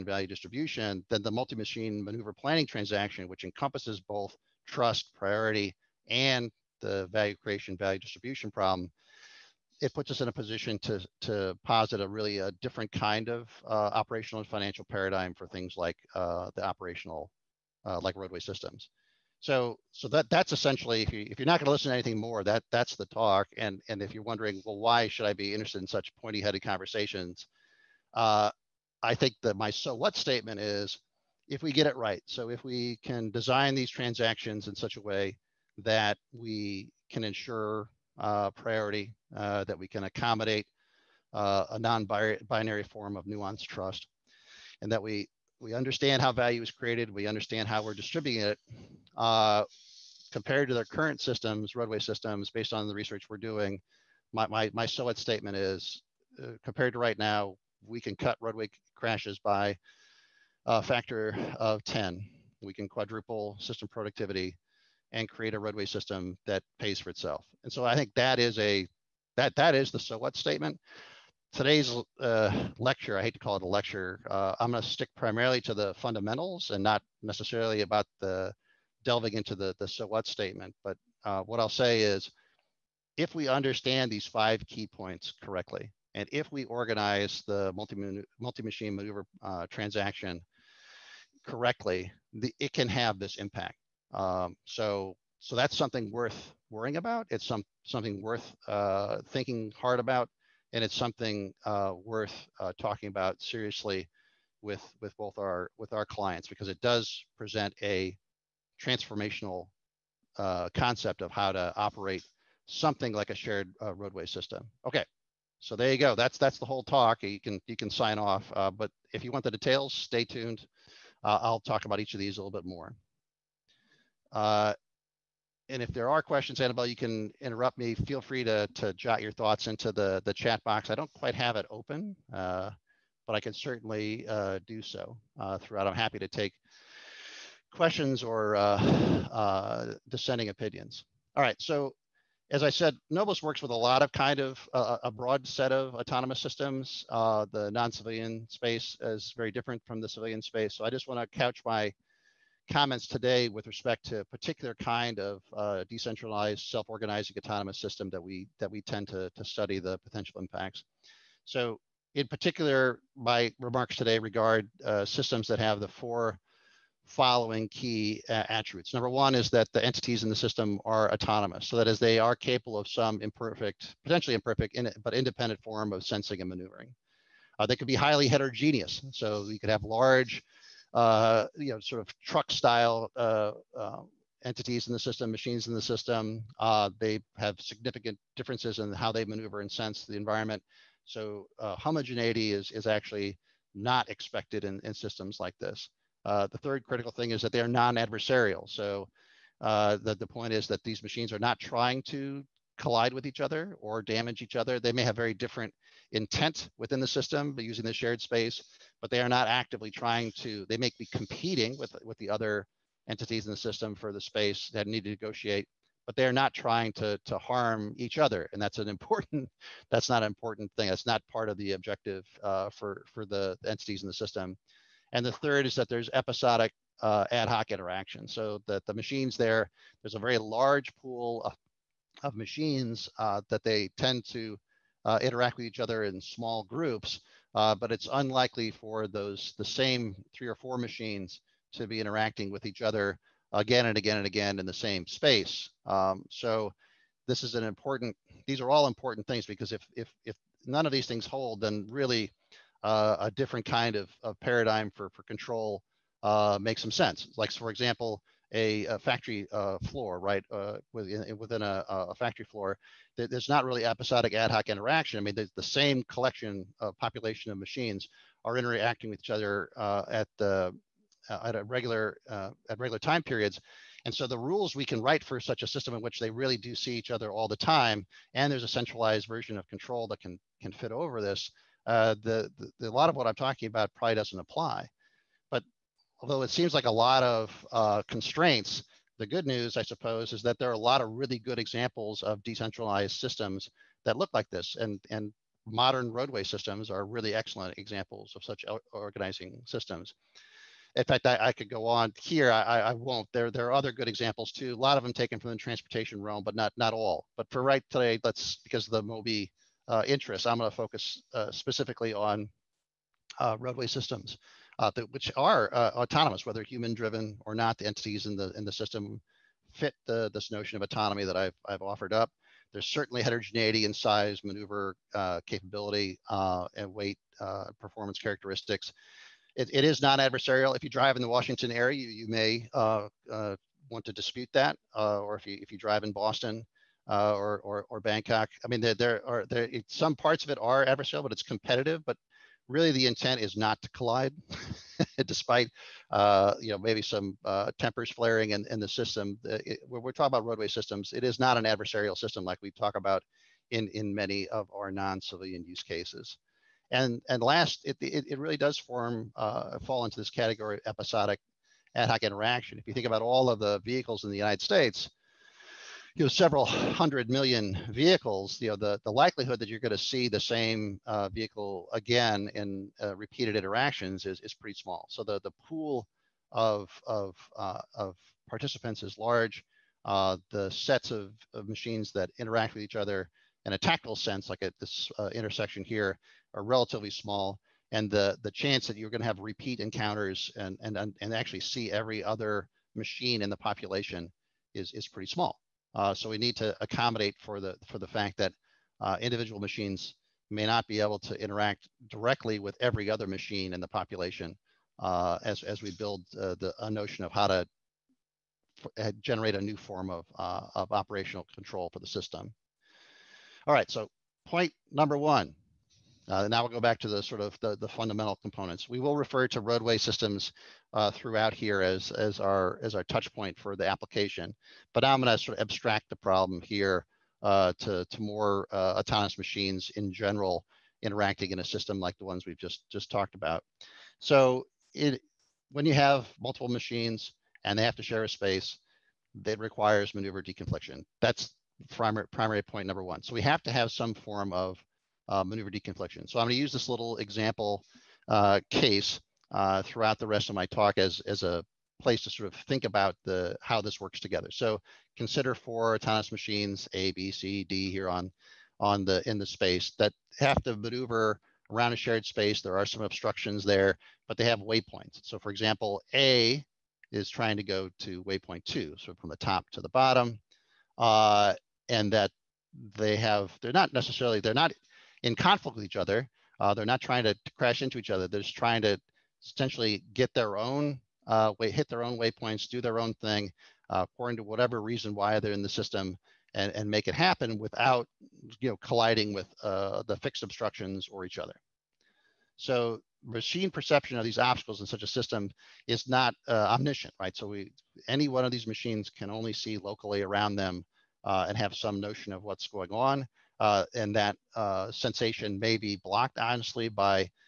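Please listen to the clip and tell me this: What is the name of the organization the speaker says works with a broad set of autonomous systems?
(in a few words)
Noblis.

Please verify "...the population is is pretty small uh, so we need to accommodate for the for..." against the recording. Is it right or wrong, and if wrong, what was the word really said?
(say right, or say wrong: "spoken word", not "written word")
right.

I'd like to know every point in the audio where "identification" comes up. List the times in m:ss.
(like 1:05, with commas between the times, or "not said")
not said.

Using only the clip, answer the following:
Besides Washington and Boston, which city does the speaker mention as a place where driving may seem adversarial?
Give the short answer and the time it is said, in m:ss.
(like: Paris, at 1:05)
Bangkok, at 5:37.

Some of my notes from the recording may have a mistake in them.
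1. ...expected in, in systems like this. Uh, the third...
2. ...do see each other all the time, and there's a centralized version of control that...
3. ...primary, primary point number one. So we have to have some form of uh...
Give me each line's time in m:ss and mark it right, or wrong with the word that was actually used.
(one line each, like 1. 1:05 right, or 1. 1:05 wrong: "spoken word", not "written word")
1. 3:14 right
2. 4:36 right
3. 7:21 right.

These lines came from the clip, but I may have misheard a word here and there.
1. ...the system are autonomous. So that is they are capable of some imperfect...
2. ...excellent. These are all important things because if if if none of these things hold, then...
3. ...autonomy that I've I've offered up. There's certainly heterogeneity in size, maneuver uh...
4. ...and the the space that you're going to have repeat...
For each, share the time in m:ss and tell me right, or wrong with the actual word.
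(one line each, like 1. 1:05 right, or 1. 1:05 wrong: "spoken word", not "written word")
1. 2:50 right
2. 4:07 wrong: "important", not "excellent"
3. 5:20 right
4. 6:27 wrong: "chance", not "space".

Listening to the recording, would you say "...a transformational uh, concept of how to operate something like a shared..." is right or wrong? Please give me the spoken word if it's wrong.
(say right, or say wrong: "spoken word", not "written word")
right.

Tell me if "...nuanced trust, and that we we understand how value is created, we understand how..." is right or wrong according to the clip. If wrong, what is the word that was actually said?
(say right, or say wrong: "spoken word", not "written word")
right.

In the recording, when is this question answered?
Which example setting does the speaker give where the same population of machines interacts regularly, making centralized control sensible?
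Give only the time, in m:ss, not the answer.
4:18.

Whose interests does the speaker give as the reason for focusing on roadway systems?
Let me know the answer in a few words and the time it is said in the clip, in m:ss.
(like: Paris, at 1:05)
MOBI, at 5:09.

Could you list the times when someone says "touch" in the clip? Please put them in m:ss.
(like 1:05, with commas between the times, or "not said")
7:03.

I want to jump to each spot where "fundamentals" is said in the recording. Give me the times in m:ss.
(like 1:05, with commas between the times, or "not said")
1:15, 6:57.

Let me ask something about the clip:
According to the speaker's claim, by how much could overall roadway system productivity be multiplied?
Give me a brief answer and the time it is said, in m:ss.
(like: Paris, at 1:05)
quadruple, at 1:02.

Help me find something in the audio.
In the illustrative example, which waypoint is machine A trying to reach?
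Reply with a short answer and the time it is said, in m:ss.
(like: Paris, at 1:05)
waypoint 2, at 7:48.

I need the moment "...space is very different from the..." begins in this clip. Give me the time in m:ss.
2:28.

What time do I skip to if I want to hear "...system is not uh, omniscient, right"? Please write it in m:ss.
8:15.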